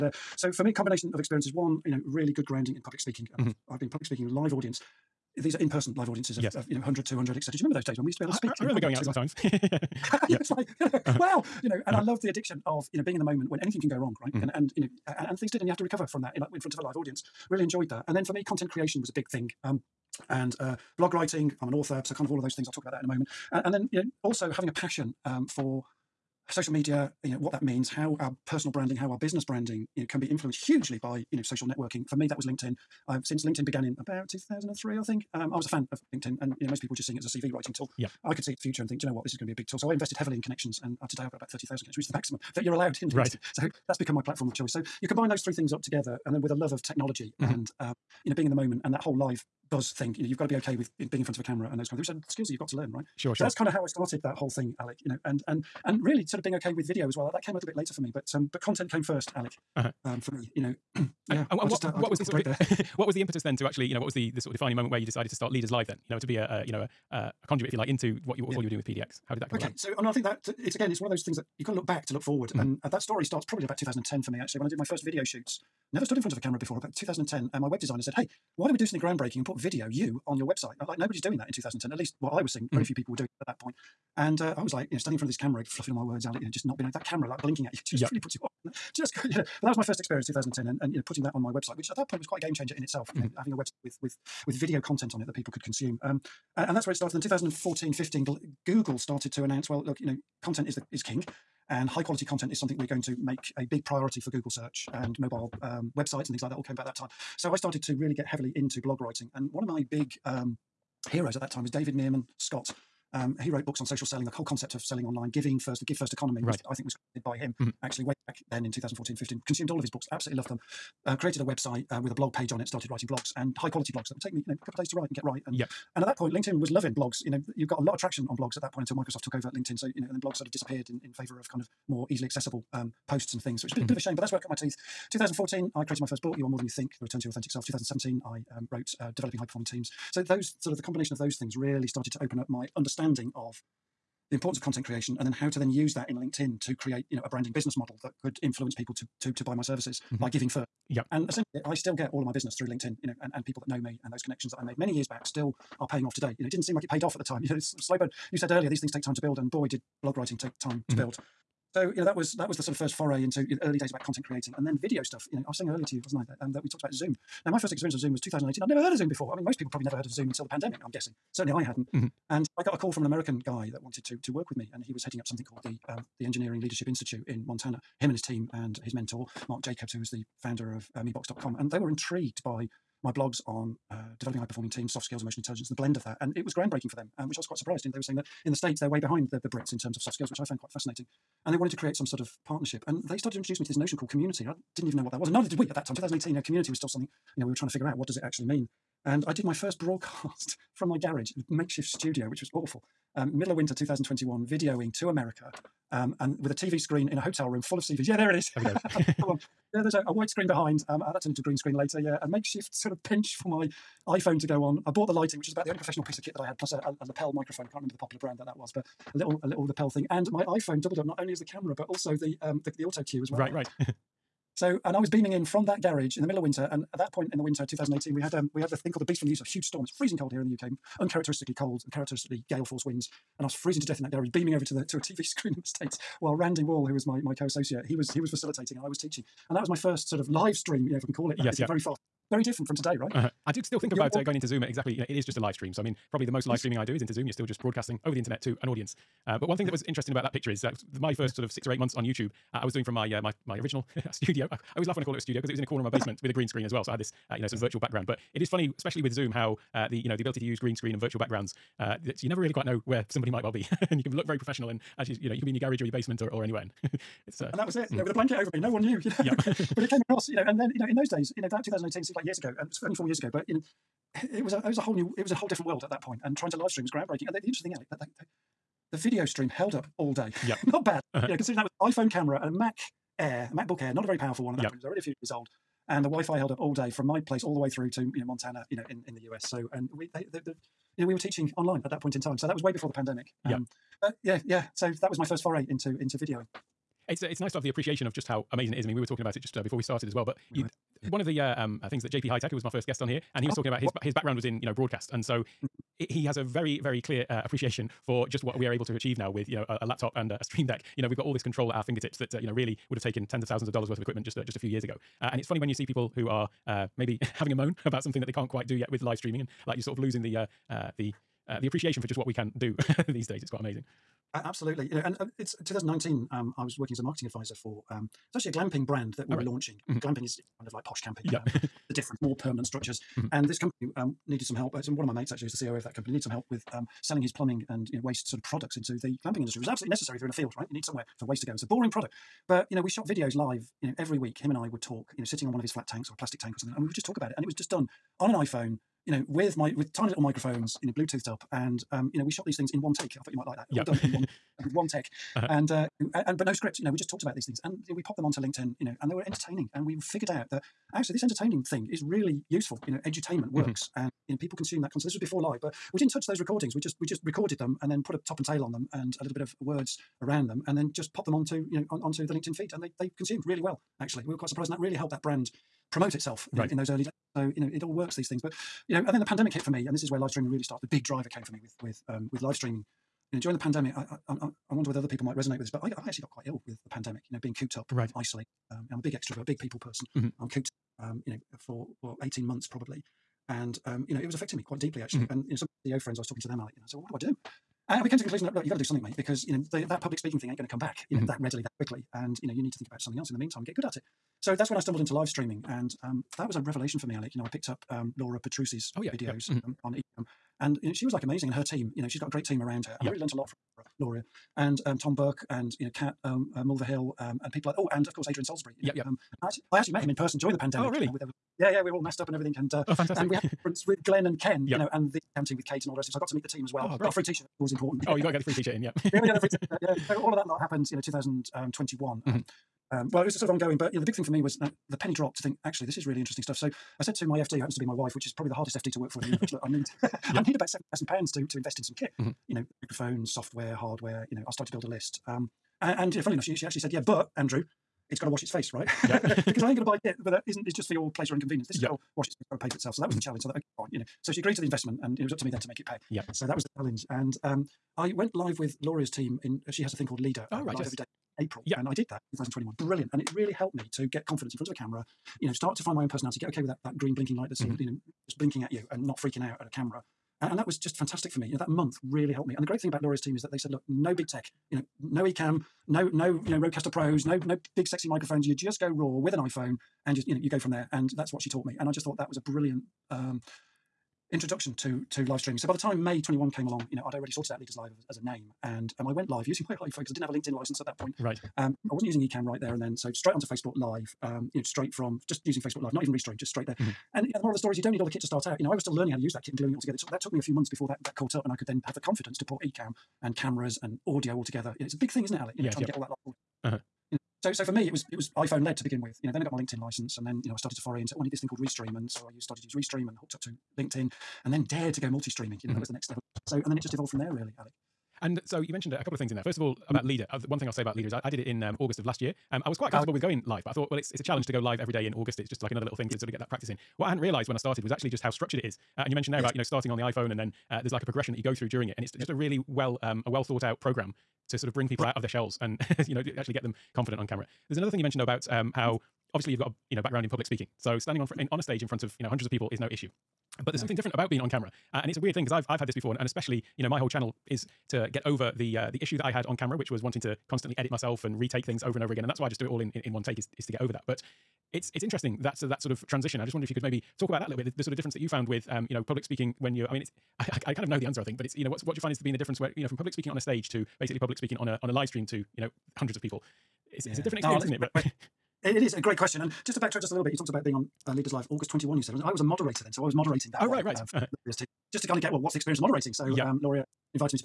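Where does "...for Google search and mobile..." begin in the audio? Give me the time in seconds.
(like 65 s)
104 s.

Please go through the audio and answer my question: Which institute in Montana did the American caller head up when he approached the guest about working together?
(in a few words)
Engineering Leadership Institute.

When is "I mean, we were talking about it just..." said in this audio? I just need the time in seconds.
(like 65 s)
298 s.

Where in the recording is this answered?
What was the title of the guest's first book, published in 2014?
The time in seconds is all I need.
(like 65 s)
136 s.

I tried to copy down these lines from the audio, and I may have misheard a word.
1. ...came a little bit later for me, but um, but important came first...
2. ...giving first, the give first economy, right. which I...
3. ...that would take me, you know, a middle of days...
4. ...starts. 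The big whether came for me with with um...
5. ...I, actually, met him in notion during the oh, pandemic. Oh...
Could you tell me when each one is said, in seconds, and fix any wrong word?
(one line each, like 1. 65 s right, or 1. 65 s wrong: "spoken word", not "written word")
1. 57 s wrong: "content", not "important"
2. 115 s right
3. 124 s wrong: "couple", not "middle"
4. 380 s wrong: "driver", not "whether"
5. 419 s wrong: "person", not "notion".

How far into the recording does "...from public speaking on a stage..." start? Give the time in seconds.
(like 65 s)
562 s.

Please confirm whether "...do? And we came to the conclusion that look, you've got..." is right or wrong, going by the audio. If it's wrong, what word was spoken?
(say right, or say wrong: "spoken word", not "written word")
right.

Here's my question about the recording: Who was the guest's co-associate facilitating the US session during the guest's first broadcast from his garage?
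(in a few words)
Randy Wall.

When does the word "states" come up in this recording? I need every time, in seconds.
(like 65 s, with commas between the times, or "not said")
188 s, 235 s.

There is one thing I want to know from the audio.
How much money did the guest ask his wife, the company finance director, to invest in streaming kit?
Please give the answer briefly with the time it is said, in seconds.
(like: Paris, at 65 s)
7,000 pounds, at 440 s.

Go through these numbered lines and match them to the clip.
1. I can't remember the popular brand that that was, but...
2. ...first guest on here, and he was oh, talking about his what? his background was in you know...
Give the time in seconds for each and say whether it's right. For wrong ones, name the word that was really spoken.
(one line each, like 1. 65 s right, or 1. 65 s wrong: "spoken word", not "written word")
1. 217 s right
2. 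302 s right.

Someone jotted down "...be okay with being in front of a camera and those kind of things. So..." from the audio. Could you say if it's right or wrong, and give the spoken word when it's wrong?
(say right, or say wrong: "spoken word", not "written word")
right.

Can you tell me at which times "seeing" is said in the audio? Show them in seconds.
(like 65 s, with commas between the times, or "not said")
37 s, 82 s.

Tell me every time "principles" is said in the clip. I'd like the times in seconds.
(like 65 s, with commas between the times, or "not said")
not said.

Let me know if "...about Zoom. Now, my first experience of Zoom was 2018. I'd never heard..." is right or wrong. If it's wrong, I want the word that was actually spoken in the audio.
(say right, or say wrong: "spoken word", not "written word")
right.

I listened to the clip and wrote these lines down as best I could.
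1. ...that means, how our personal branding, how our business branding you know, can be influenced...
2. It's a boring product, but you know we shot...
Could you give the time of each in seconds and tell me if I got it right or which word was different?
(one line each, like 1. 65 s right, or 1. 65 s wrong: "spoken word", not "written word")
1. 27 s right
2. 341 s right.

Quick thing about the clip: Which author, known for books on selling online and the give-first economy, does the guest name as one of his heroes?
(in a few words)
David Meerman Scott.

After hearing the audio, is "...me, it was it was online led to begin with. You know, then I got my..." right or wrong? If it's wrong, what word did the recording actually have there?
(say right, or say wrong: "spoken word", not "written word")
wrong: "iPhone", not "online".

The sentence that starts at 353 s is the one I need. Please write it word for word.
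I thought you might like that.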